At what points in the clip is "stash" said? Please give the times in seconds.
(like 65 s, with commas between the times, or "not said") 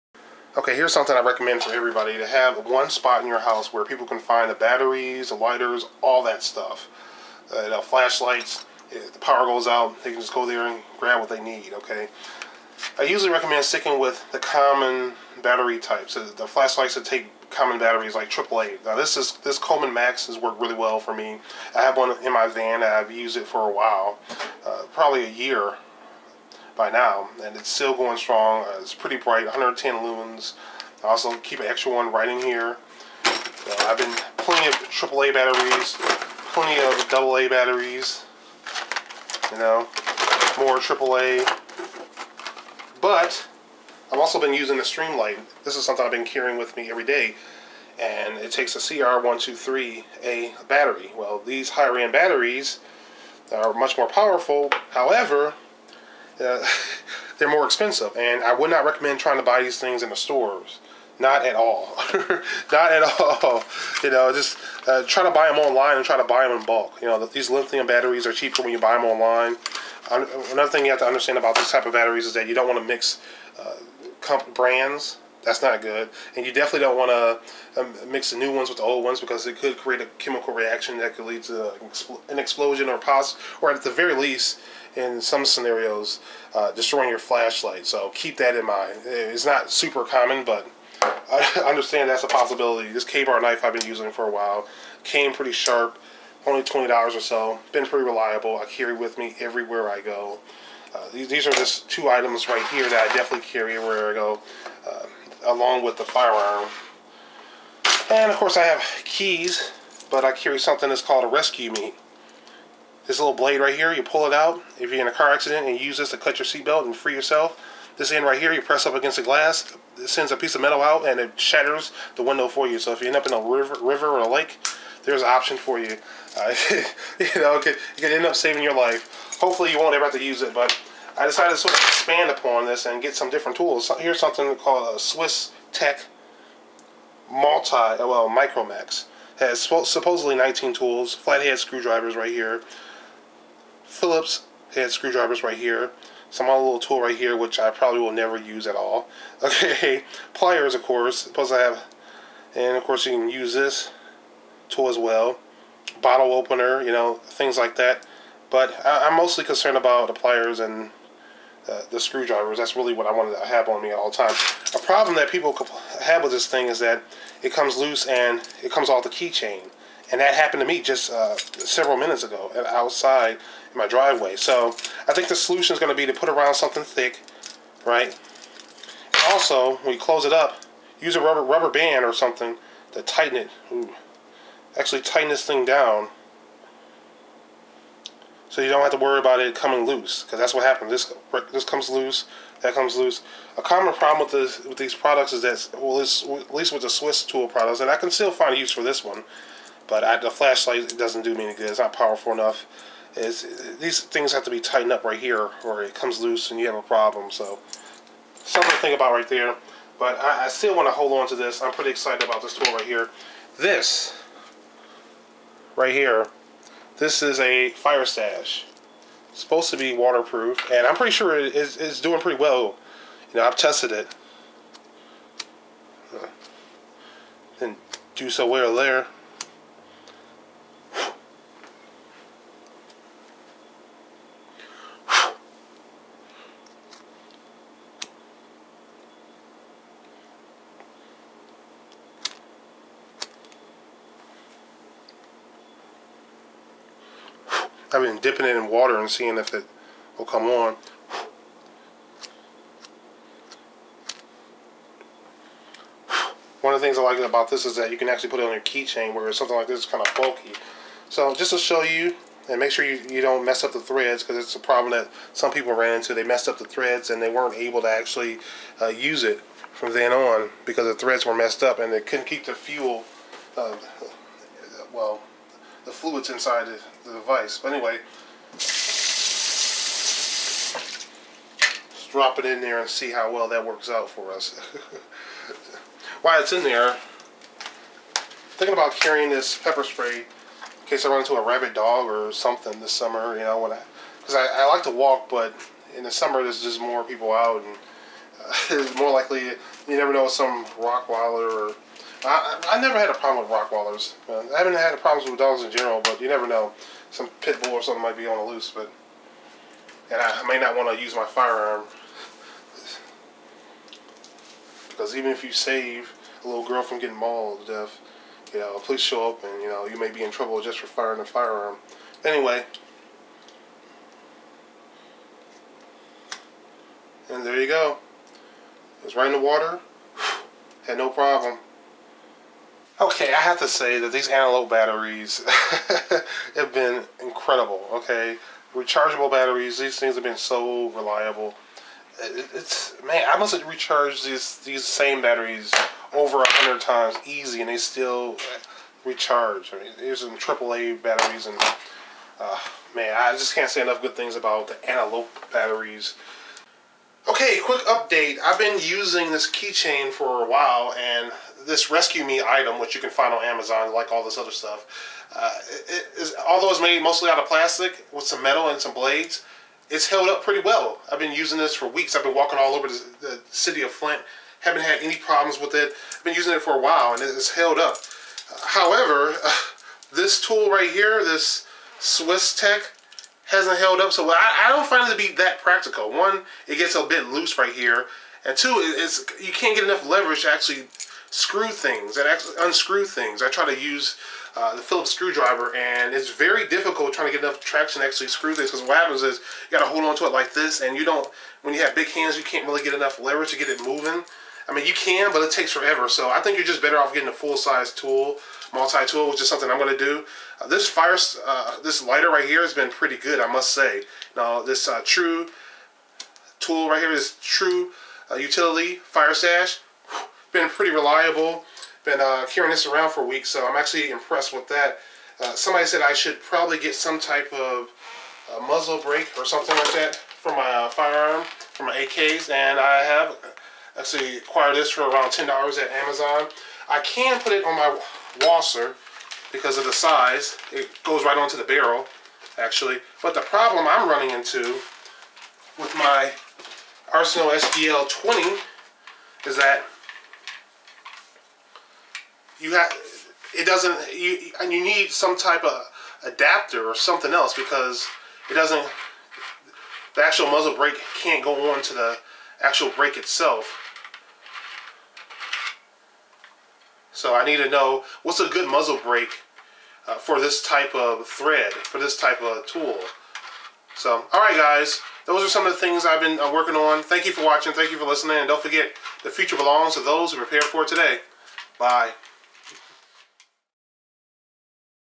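218 s, 419 s.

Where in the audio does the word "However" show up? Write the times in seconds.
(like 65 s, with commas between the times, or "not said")
54 s, 378 s.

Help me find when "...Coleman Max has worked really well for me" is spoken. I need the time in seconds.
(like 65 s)
19 s.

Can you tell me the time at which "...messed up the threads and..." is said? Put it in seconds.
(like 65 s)
266 s.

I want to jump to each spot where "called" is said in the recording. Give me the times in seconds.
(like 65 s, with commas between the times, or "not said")
111 s, 134 s.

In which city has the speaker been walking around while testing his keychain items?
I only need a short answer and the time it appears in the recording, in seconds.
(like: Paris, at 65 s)
Flint, at 373 s.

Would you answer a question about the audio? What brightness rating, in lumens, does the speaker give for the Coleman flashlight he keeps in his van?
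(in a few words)
110.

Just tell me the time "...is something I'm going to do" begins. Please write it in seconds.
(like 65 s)
409 s.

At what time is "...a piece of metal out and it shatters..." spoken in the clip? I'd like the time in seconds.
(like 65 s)
120 s.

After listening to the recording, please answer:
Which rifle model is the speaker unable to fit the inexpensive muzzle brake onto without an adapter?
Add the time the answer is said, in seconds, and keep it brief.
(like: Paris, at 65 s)
Arsenal SDL 20, at 447 s.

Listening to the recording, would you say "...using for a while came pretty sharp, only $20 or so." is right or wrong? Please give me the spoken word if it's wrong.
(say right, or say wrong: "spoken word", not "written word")
right.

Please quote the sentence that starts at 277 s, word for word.
But anyway, just drop it in there and see how well that works out for us.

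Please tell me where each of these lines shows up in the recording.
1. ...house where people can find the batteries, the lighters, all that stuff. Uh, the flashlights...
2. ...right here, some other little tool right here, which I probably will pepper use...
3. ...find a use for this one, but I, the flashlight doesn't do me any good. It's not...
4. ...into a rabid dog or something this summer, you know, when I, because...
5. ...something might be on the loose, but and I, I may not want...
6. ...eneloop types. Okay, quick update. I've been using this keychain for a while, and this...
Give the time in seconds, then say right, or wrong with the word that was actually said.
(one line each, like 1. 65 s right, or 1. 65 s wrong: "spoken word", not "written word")
1. 3 s right
2. 145 s wrong: "never", not "pepper"
3. 198 s right
4. 291 s right
5. 307 s right
6. 354 s wrong: "batteries", not "types".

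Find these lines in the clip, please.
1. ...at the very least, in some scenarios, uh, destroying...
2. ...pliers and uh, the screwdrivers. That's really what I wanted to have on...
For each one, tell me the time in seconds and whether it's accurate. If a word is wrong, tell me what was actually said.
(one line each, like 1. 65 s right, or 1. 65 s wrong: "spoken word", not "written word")
1. 83 s right
2. 160 s right.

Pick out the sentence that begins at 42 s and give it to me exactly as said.
But I've also been using the Streamlight.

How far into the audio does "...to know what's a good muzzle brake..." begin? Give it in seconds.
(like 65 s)
467 s.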